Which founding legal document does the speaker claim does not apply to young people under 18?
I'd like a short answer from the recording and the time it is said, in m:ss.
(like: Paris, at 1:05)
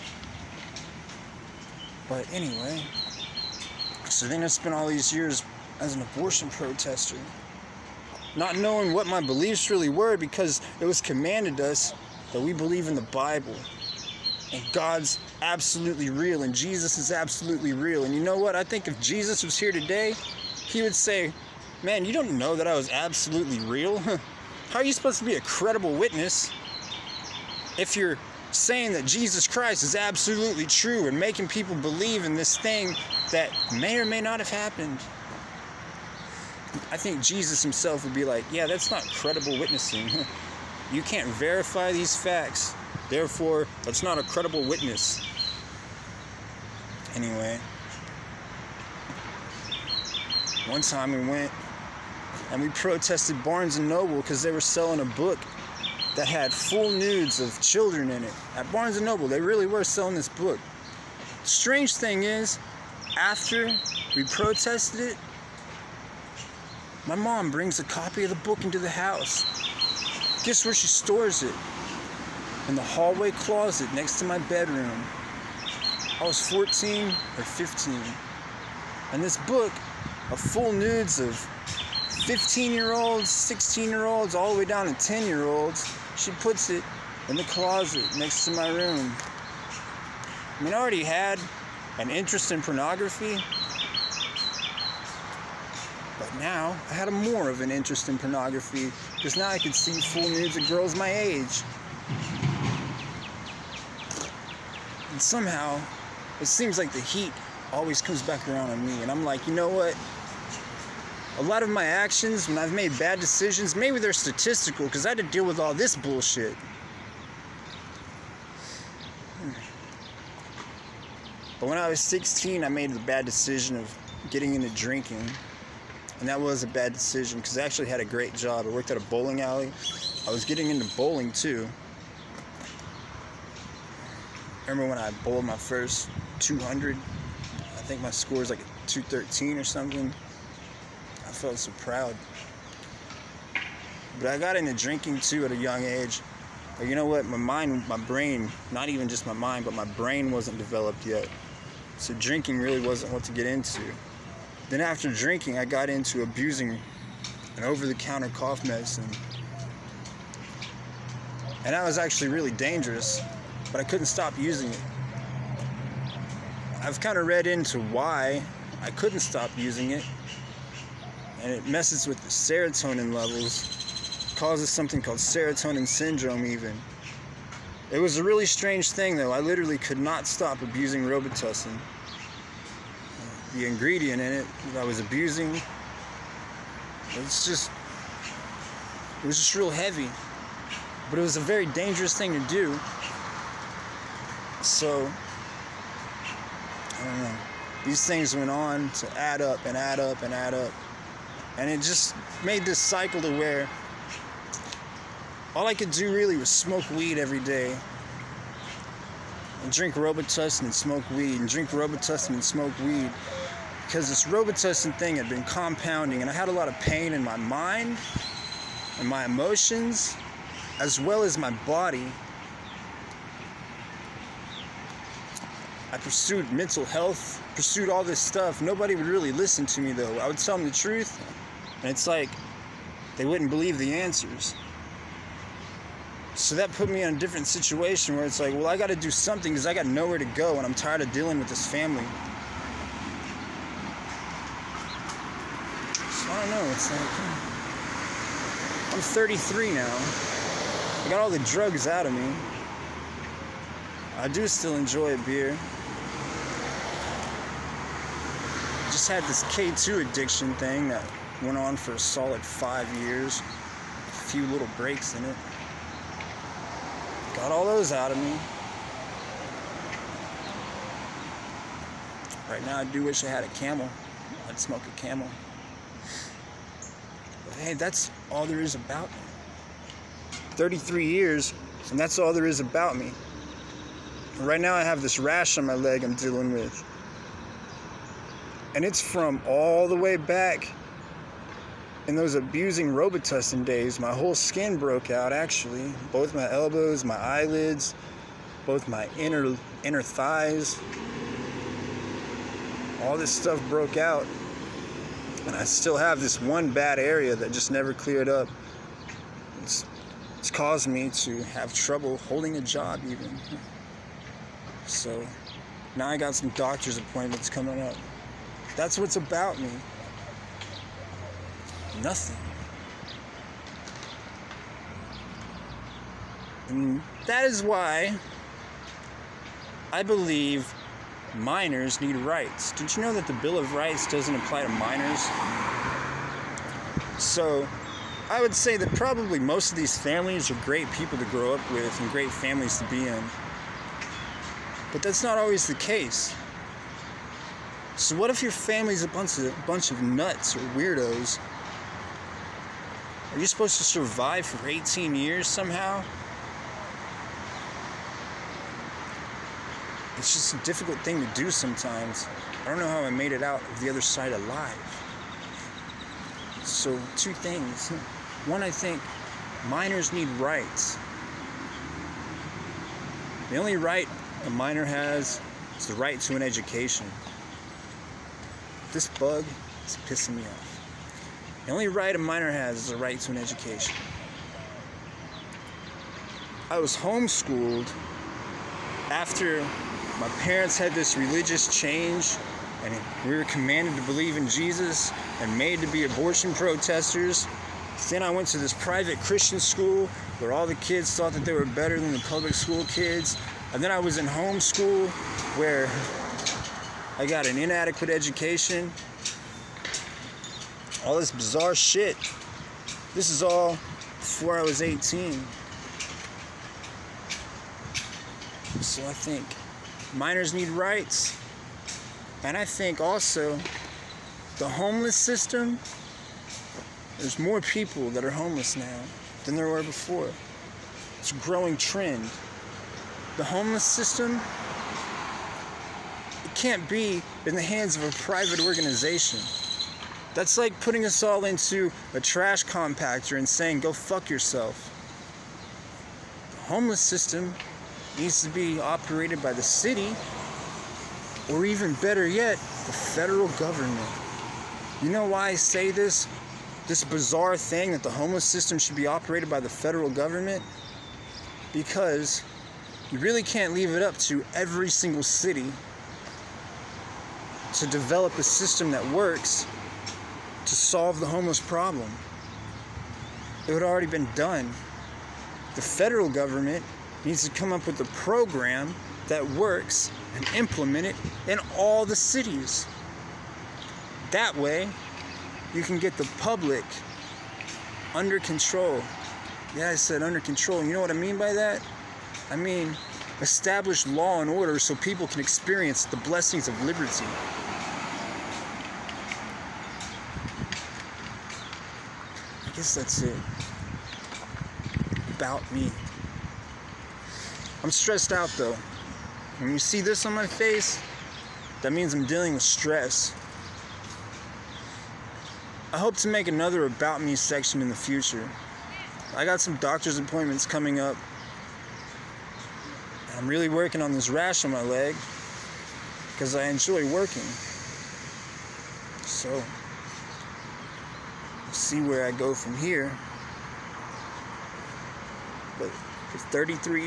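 Bill of Rights, at 5:33.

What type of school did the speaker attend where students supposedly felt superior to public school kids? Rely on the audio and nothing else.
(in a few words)
Private Christian school.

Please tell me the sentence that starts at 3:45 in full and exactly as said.
I pursued mental health, pursued all this stuff.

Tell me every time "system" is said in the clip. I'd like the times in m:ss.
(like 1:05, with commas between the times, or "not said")
7:05, 7:13, 7:27, 7:38, 7:48.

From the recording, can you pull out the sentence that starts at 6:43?
And then I was in homeschool where I got an inadequate education all this bizarre shit.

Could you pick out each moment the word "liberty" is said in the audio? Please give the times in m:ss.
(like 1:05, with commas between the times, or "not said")
8:16.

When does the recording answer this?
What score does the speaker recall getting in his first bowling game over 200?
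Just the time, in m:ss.
2:18.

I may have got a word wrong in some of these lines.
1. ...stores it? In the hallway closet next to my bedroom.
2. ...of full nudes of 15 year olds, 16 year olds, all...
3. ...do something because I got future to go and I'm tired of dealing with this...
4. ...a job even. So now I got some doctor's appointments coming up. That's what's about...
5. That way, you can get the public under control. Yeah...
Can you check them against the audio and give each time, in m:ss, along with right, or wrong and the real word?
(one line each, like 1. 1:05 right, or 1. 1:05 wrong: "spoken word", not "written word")
1. 1:10 right
2. 1:20 right
3. 3:58 wrong: "nowhere", not "future"
4. 5:12 right
5. 8:04 right.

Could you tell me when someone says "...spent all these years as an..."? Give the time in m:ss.
0:04.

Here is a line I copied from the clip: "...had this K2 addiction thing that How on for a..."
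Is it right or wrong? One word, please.
wrong.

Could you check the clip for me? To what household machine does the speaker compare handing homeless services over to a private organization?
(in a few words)
Trash compactor.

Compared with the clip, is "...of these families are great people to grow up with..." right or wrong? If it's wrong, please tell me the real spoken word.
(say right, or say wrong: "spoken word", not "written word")
right.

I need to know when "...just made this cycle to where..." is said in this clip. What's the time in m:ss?
3:21.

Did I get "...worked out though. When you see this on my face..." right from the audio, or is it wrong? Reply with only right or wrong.
wrong.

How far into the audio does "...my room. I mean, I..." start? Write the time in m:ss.
1:28.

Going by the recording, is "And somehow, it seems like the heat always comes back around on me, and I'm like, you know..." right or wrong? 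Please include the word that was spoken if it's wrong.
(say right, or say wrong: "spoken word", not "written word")
right.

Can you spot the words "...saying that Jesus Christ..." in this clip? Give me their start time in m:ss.
0:28.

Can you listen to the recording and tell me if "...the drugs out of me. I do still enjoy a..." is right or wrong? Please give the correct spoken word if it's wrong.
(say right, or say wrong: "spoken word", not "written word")
right.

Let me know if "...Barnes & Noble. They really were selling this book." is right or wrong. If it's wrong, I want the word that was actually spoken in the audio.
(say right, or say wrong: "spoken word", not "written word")
right.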